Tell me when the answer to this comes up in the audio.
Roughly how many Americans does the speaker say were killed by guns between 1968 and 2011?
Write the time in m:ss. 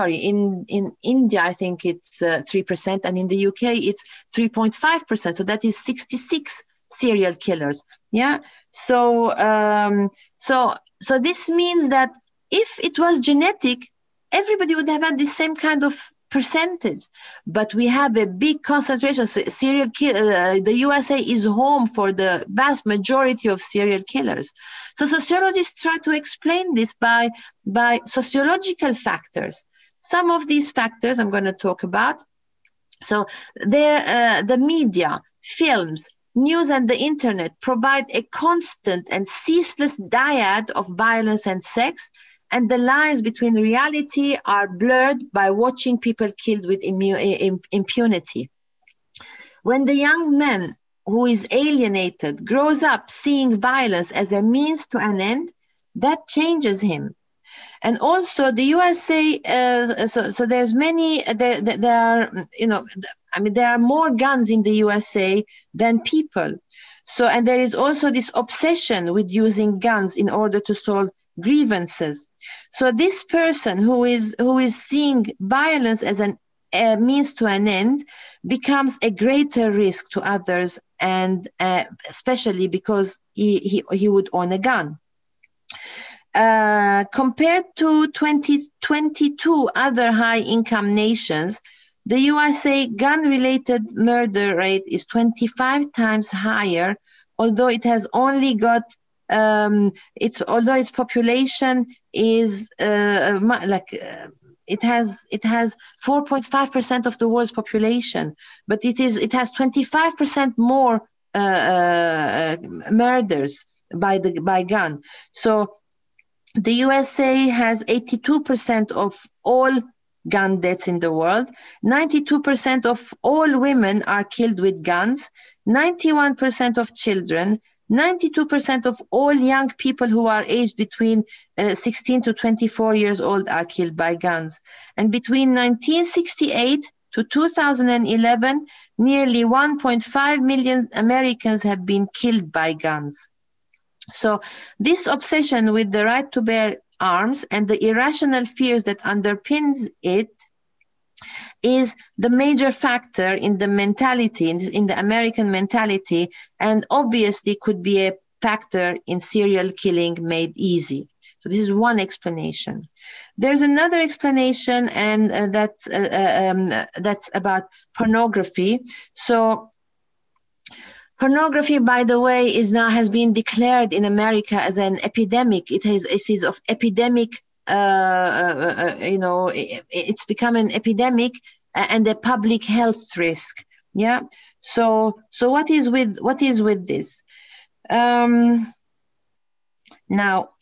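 2:19.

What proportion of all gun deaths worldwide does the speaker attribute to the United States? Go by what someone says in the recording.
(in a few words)
82%.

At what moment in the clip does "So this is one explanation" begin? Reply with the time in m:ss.
2:41.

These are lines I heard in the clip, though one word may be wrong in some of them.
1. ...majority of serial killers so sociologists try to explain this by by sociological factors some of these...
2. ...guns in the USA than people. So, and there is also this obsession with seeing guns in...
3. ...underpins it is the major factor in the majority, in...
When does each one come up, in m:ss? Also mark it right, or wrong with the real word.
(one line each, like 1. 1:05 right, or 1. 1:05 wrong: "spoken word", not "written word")
1. 0:22 right
2. 1:04 wrong: "using", not "seeing"
3. 2:28 wrong: "mentality", not "majority".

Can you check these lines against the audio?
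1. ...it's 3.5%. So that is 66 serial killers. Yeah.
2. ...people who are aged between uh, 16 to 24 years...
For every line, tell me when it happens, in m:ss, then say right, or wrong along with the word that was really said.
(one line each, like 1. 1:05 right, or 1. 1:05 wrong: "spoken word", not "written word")
1. 0:03 right
2. 2:09 right.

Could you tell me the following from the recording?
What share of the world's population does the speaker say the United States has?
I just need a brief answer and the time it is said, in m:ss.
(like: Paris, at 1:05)
4.5%, at 1:46.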